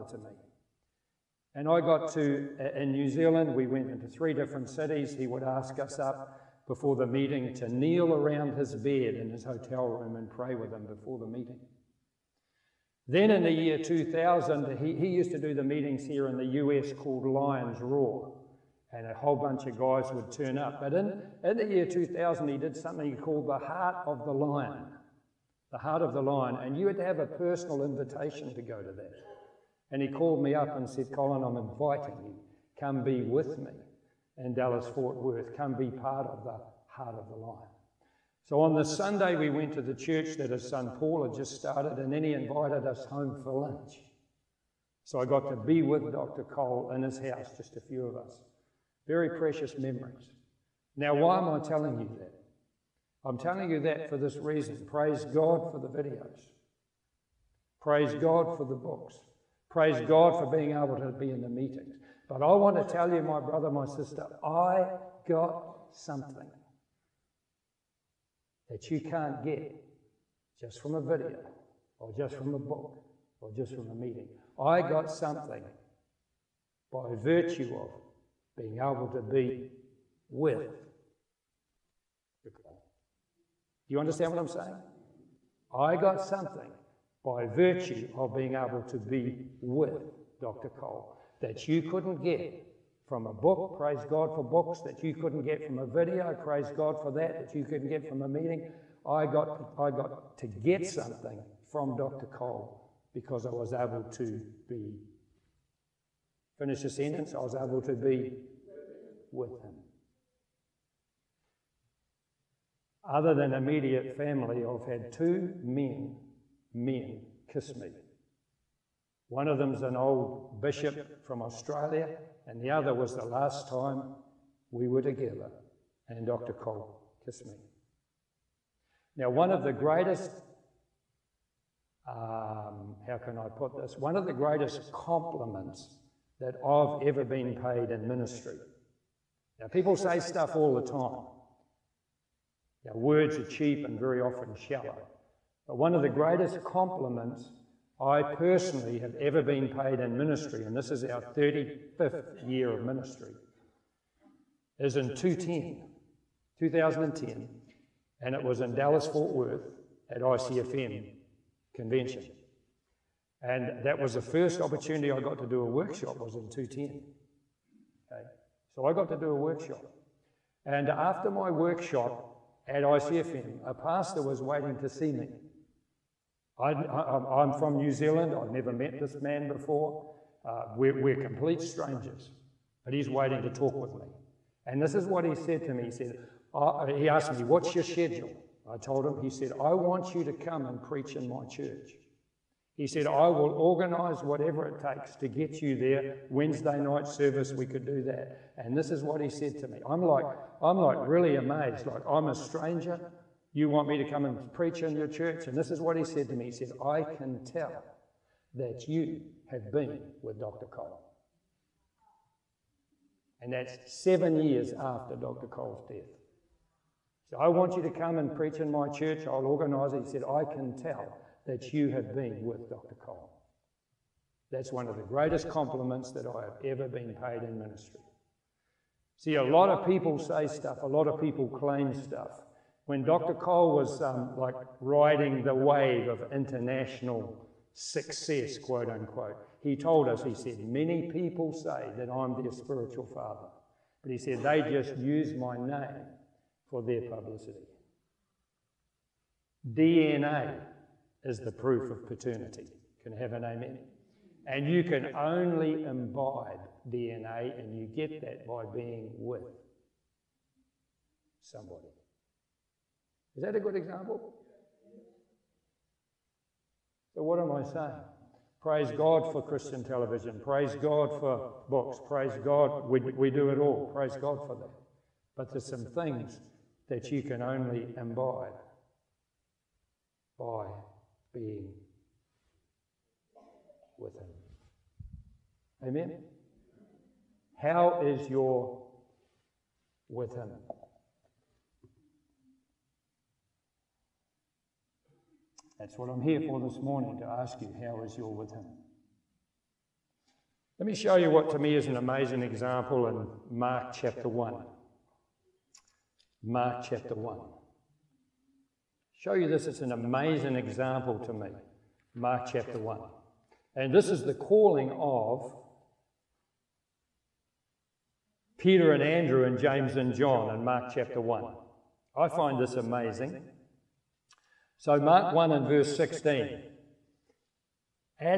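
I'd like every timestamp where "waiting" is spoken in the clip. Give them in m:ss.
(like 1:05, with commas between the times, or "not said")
2:54, 3:03.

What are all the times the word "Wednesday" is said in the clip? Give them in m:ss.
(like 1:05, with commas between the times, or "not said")
3:16.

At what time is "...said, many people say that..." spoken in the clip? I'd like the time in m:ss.
4:00.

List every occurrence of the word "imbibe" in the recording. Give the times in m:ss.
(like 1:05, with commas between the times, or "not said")
4:15, 4:37.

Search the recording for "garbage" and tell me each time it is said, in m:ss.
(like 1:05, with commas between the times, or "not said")
not said.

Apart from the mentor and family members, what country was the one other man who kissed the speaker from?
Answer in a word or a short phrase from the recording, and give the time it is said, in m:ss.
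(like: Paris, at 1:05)
Australia, at 2:01.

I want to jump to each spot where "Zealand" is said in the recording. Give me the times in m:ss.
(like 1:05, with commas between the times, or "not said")
0:03, 2:57.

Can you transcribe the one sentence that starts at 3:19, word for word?
I'm like, I'm like really amazed.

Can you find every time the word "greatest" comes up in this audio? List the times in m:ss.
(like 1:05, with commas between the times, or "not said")
2:09, 2:14, 2:26, 3:45.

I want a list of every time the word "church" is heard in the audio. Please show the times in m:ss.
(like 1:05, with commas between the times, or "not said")
0:39, 3:11, 3:25, 3:38.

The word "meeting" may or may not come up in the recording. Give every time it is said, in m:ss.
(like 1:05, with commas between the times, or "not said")
0:07, 0:11, 0:15, 1:01, 1:13, 1:38.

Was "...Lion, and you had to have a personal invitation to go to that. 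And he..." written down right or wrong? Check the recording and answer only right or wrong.
right.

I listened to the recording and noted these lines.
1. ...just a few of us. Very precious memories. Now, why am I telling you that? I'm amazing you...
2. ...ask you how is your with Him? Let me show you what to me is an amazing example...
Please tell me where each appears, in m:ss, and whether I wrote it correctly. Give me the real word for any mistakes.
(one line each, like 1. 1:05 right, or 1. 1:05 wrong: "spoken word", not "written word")
1. 0:47 wrong: "telling", not "amazing"
2. 4:57 right.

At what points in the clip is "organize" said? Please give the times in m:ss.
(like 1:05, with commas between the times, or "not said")
3:13, 3:39.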